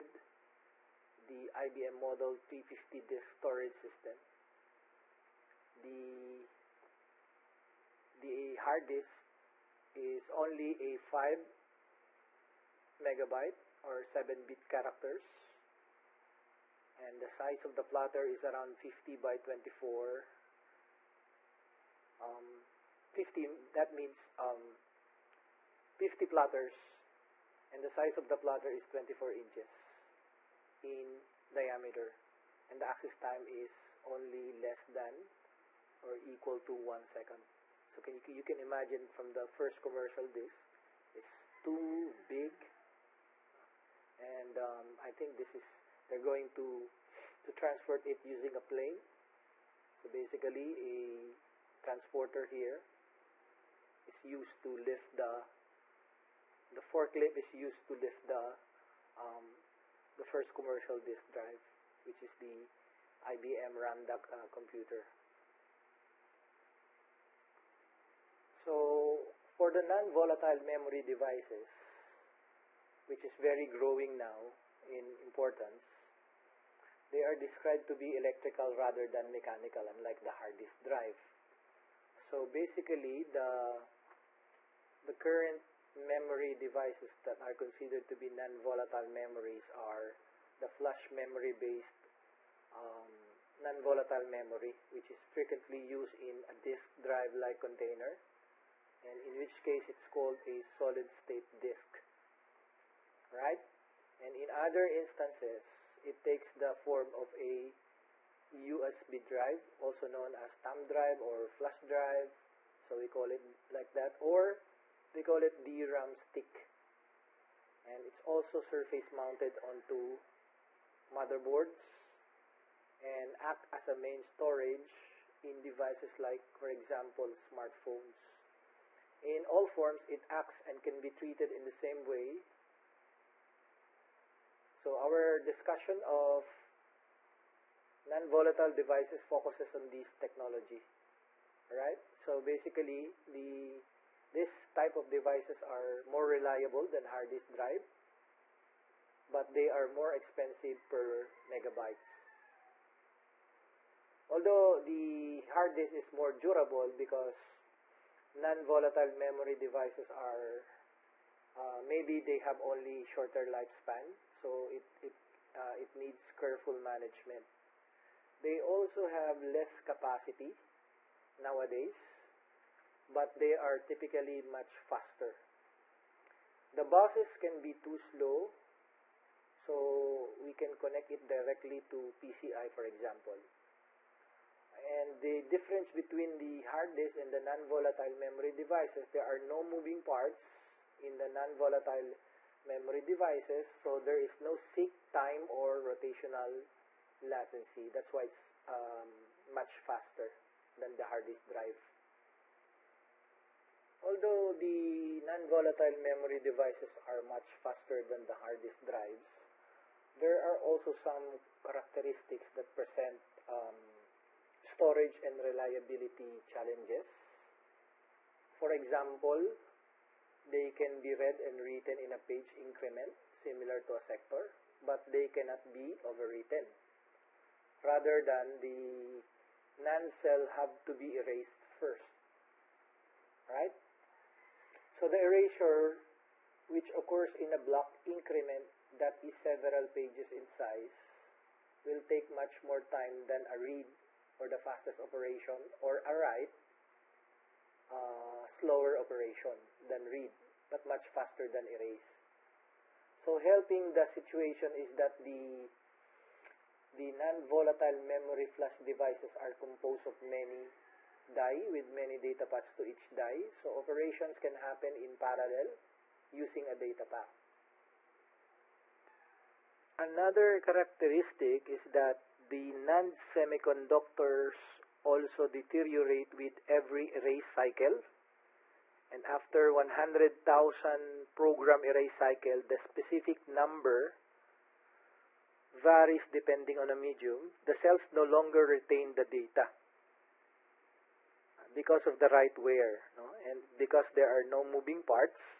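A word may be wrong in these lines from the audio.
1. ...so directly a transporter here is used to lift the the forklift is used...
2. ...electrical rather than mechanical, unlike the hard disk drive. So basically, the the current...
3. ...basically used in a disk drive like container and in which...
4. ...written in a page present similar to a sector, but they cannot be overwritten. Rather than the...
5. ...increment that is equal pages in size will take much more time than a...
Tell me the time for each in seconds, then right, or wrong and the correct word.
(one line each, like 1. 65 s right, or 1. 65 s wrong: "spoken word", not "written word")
1. 49 s wrong: "basically", not "directly"
2. 78 s right
3. 95 s wrong: "frequently", not "basically"
4. 221 s wrong: "increment", not "present"
5. 238 s wrong: "several", not "equal".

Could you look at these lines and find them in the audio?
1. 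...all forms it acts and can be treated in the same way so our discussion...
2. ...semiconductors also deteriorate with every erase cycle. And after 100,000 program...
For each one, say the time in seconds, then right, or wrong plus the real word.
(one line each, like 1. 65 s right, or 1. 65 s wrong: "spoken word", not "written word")
1. 129 s right
2. 273 s right.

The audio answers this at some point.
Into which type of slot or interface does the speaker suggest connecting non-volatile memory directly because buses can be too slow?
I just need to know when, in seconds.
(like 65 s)
182 s.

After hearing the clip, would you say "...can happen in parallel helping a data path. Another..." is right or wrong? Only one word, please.
wrong.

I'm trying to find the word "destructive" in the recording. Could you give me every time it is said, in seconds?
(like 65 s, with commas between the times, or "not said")
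not said.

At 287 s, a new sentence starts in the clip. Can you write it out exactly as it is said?
The cells no longer retain the data because of the write wear no?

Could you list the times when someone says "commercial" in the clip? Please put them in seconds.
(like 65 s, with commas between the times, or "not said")
39 s, 60 s.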